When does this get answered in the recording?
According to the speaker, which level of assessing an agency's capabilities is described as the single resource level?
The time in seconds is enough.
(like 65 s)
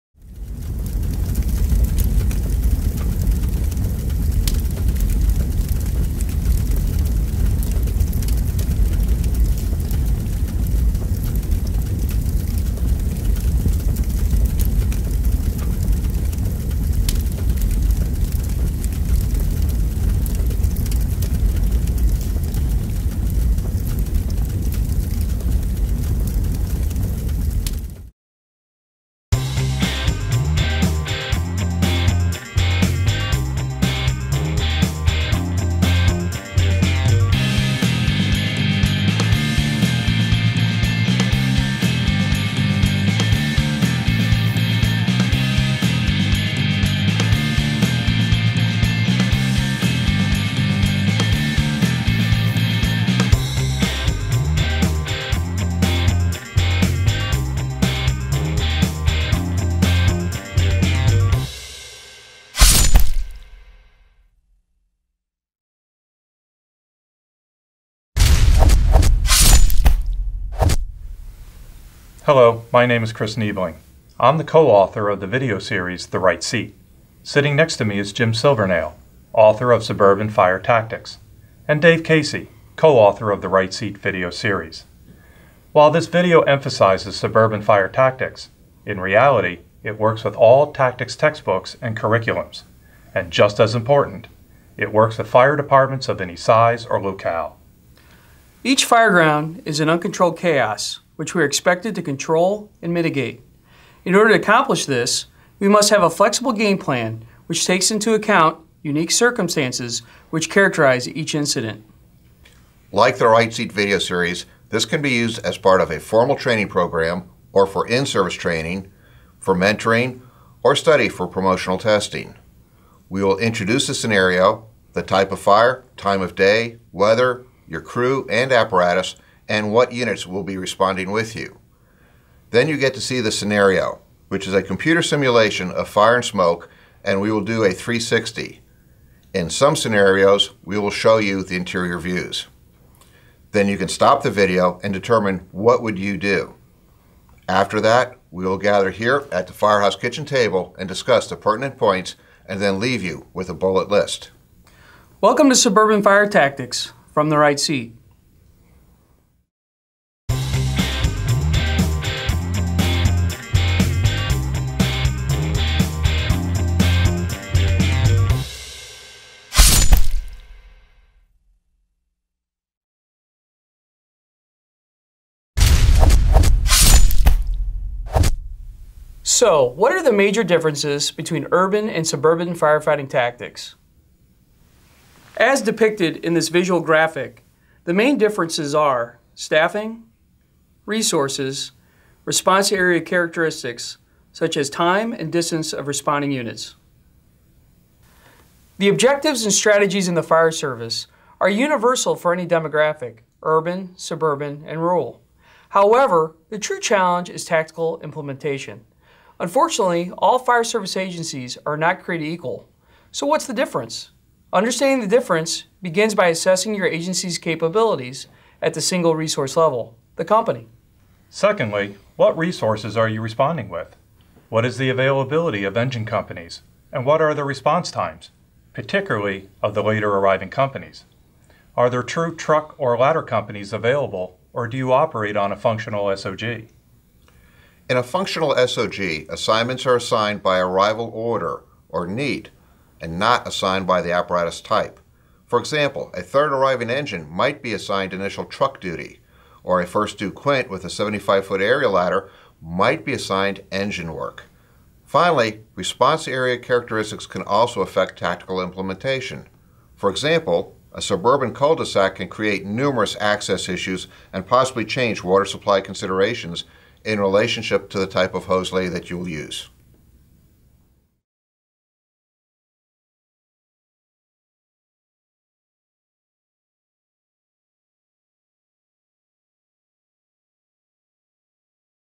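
220 s.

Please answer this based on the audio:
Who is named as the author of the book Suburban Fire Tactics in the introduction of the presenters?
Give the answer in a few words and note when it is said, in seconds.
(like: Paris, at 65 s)
Jim Silvernail, at 78 s.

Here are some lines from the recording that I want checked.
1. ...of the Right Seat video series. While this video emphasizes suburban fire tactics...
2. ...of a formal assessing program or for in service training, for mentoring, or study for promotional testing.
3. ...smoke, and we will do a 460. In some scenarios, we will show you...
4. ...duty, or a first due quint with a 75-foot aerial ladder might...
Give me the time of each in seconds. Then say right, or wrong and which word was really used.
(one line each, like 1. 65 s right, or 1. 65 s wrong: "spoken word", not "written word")
1. 83 s right
2. 115 s wrong: "training", not "assessing"
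3. 136 s wrong: "360", not "460"
4. 248 s right.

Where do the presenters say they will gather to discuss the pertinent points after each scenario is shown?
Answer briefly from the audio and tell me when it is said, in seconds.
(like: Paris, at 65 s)
firehouse kitchen table, at 149 s.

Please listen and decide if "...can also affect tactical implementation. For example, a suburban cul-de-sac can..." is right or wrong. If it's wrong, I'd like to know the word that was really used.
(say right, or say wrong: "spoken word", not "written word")
right.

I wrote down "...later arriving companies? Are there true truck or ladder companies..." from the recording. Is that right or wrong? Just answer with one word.
right.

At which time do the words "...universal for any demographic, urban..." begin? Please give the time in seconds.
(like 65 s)
201 s.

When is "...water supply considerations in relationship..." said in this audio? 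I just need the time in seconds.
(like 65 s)
265 s.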